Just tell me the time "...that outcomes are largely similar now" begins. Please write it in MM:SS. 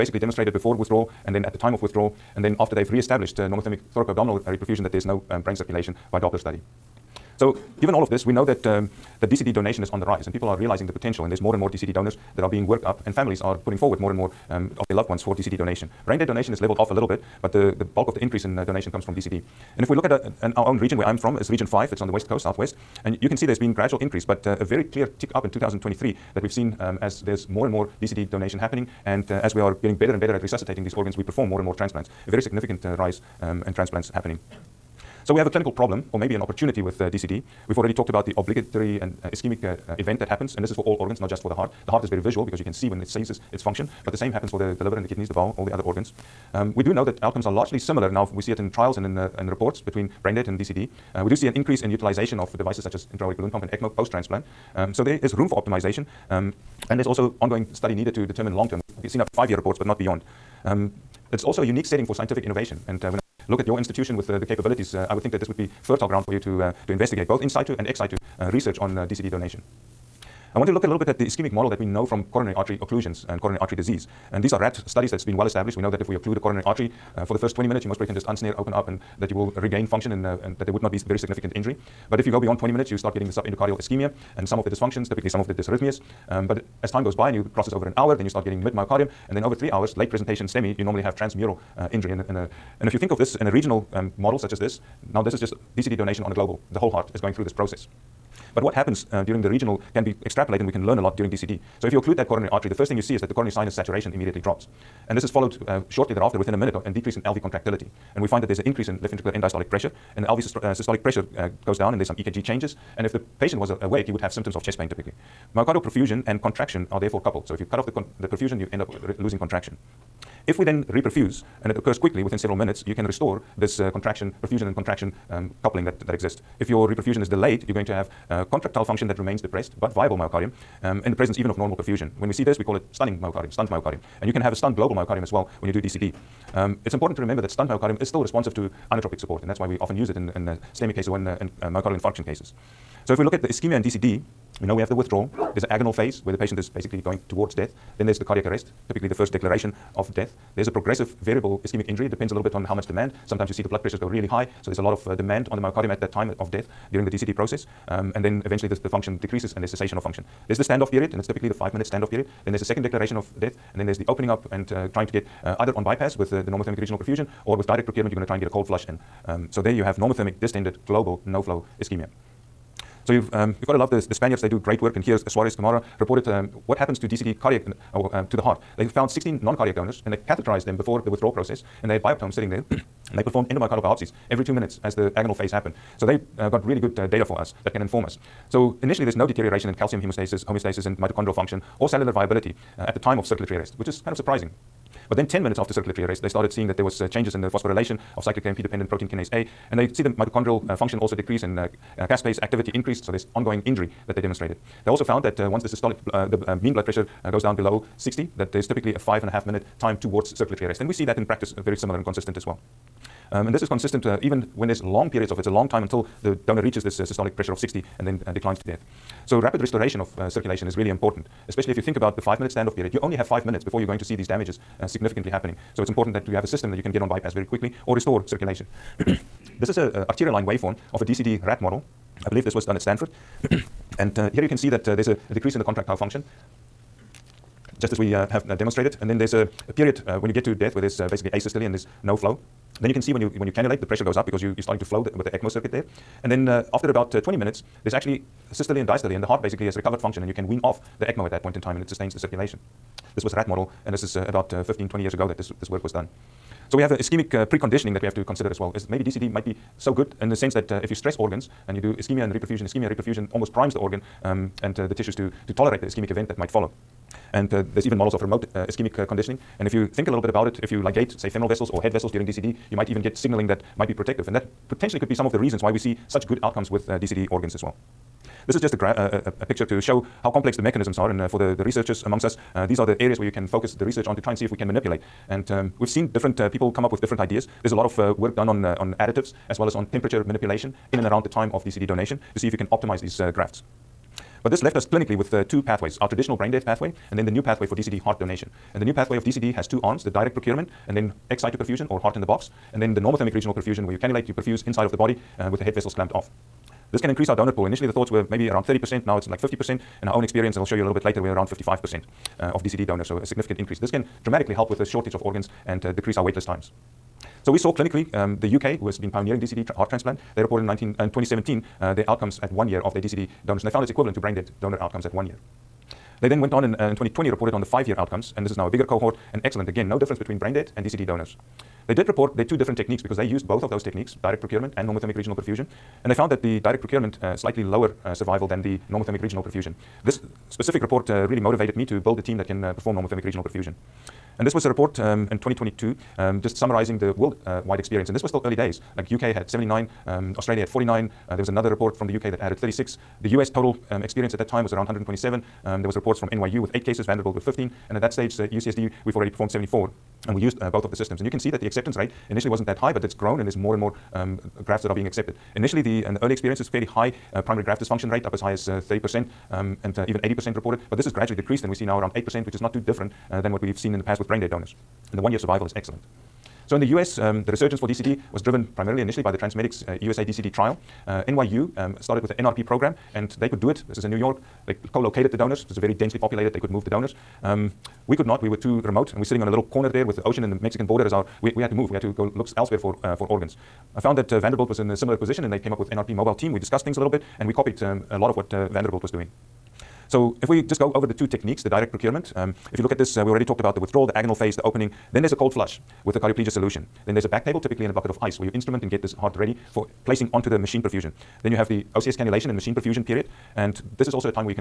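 00:47.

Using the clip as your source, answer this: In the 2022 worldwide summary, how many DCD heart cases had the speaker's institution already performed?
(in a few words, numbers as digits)
74.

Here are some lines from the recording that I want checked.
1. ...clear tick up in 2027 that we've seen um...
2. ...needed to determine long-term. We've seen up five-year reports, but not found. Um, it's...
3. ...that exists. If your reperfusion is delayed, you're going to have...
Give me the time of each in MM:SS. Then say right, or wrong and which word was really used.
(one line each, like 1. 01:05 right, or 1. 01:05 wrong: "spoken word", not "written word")
1. 00:24 wrong: "2023", not "2027"
2. 00:57 wrong: "beyond", not "found"
3. 02:06 right.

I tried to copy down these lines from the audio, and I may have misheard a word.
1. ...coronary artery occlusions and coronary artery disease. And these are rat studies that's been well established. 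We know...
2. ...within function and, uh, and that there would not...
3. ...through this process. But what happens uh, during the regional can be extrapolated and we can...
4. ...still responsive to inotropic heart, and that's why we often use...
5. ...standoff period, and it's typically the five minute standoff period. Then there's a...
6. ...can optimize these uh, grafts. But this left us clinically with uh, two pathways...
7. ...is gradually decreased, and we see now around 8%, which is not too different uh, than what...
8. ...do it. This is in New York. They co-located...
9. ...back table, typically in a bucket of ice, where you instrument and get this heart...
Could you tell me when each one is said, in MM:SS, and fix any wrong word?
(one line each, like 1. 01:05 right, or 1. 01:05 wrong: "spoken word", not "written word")
1. 01:12 right
2. 01:19 wrong: "regain", not "within"
3. 01:37 right
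4. 02:18 wrong: "support", not "heart"
5. 02:40 right
6. 04:52 right
7. 06:11 right
8. 06:23 right
9. 06:47 right.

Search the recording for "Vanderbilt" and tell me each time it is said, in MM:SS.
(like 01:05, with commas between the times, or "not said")
05:57, 06:34, 06:38.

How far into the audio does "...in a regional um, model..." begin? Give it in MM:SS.
01:33.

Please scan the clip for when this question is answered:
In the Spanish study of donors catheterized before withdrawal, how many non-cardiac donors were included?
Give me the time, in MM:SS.
02:59.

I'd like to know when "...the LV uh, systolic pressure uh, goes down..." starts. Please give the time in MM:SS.
01:50.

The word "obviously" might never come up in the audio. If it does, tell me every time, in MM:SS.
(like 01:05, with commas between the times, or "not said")
not said.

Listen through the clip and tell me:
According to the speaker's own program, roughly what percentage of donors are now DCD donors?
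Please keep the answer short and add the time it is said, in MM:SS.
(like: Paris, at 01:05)
55%, at 05:11.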